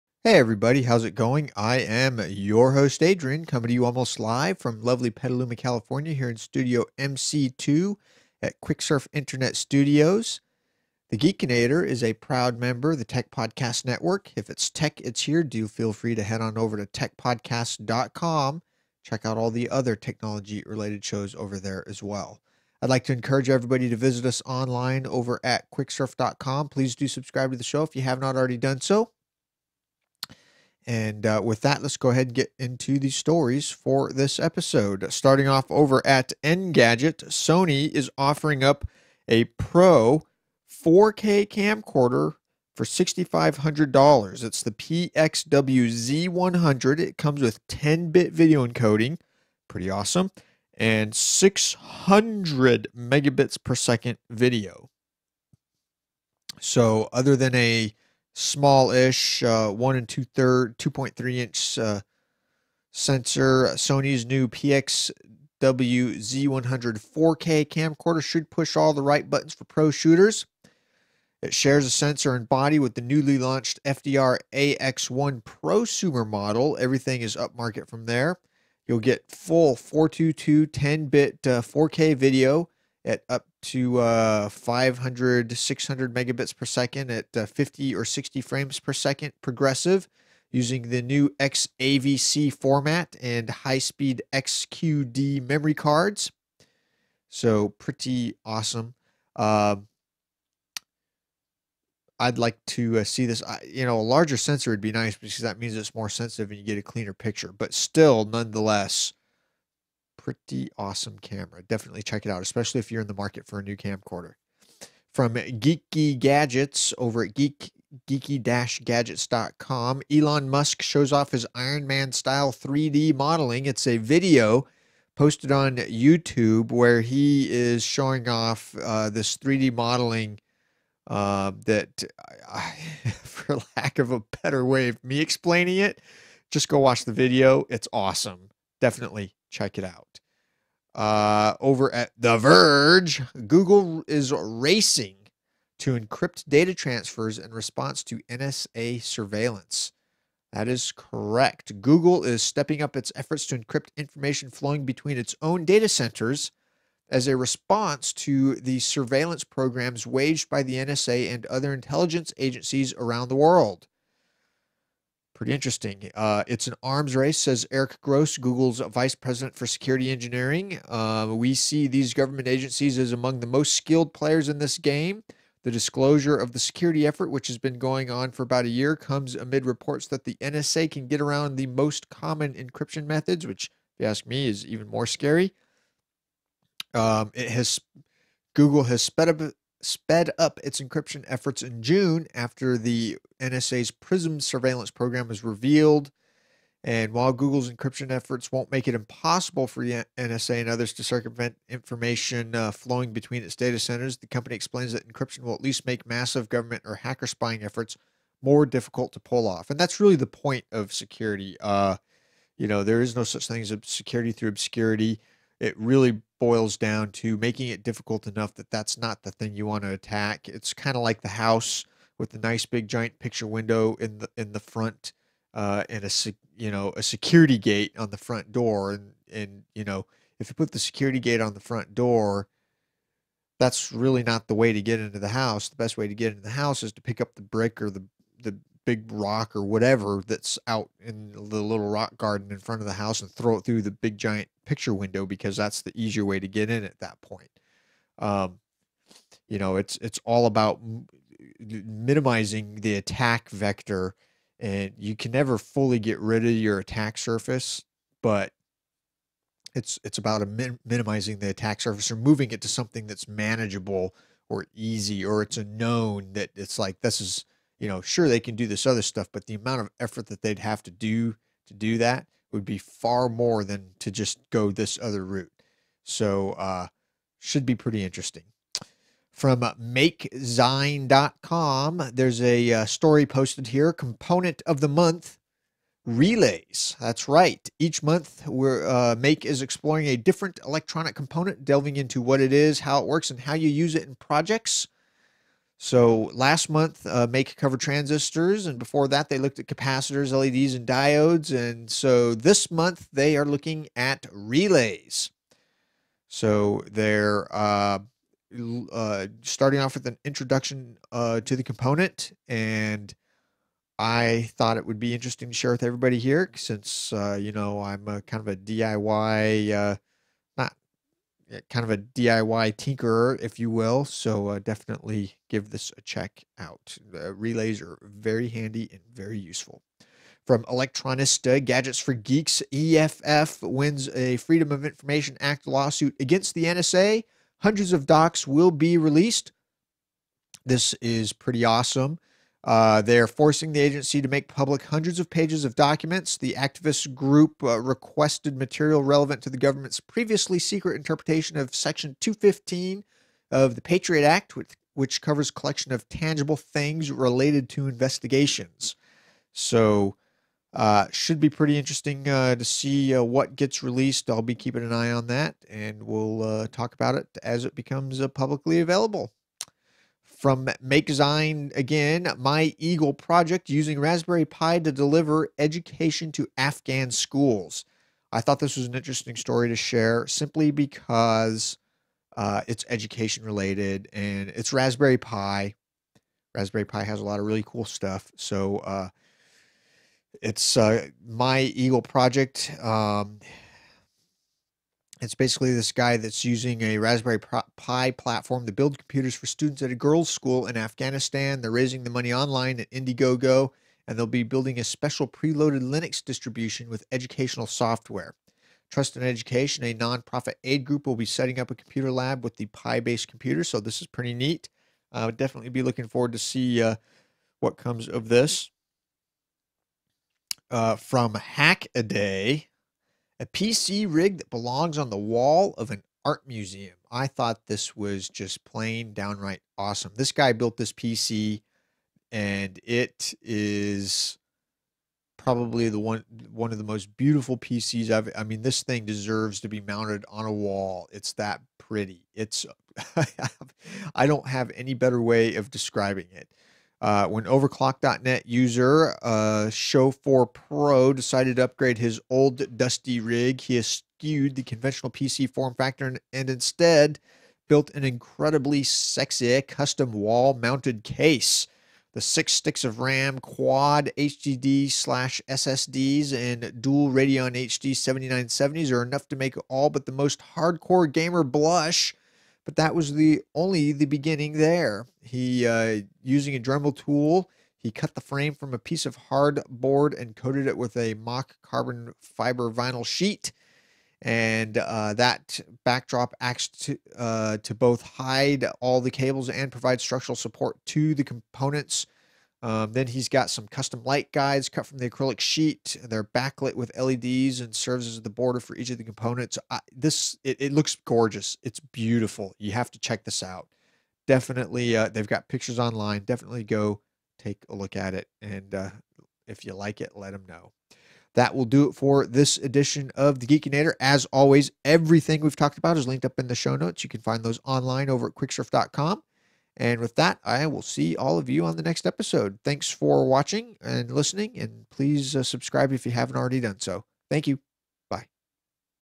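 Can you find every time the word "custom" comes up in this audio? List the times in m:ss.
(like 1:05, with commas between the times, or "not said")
7:39, 8:13.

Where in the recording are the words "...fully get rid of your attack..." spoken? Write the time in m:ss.
4:15.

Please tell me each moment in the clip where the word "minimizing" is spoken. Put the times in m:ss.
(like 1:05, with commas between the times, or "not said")
4:11, 4:20.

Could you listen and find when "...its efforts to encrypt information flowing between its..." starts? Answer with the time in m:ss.
2:32.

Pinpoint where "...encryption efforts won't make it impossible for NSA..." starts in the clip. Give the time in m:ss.
3:17.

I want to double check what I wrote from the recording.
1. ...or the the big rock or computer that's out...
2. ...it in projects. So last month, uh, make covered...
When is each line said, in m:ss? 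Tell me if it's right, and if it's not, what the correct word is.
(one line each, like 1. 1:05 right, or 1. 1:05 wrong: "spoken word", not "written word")
1. 3:57 wrong: "whatever", not "computer"
2. 4:53 right.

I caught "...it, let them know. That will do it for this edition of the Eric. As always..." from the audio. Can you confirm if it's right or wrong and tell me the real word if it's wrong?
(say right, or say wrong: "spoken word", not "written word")
wrong: "Geekinator", not "Eric".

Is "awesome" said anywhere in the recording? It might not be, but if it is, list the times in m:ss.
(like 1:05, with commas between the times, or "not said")
0:49, 1:38, 1:50, 2:17, 5:41, 7:09.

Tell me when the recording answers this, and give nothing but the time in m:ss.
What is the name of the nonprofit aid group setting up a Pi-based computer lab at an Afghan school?
6:48.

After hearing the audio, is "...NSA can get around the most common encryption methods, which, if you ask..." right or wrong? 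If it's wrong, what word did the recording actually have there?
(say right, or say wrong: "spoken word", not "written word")
right.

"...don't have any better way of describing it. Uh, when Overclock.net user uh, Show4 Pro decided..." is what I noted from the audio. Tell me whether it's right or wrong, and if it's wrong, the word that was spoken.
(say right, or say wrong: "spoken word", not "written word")
right.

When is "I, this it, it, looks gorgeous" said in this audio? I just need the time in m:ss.
8:19.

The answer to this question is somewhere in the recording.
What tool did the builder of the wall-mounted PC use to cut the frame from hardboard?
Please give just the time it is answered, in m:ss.
7:56.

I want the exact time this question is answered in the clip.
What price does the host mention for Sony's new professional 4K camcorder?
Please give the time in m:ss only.
0:42.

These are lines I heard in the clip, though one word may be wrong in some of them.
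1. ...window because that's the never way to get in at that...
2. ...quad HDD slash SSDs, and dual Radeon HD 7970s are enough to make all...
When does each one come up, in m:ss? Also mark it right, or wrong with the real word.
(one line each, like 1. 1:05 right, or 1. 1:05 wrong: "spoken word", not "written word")
1. 4:04 wrong: "easier", not "never"
2. 7:43 right.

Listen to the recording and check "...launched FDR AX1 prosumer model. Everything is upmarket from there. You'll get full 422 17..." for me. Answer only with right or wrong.
wrong.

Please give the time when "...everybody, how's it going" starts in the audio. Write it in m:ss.
0:00.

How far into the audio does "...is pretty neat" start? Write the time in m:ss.
6:54.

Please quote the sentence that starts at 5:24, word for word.
So uh, definitely give this a check out.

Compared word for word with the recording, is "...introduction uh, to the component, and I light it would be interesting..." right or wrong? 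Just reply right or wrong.
wrong.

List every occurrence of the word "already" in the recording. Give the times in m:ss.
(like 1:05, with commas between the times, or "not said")
0:28, 8:46.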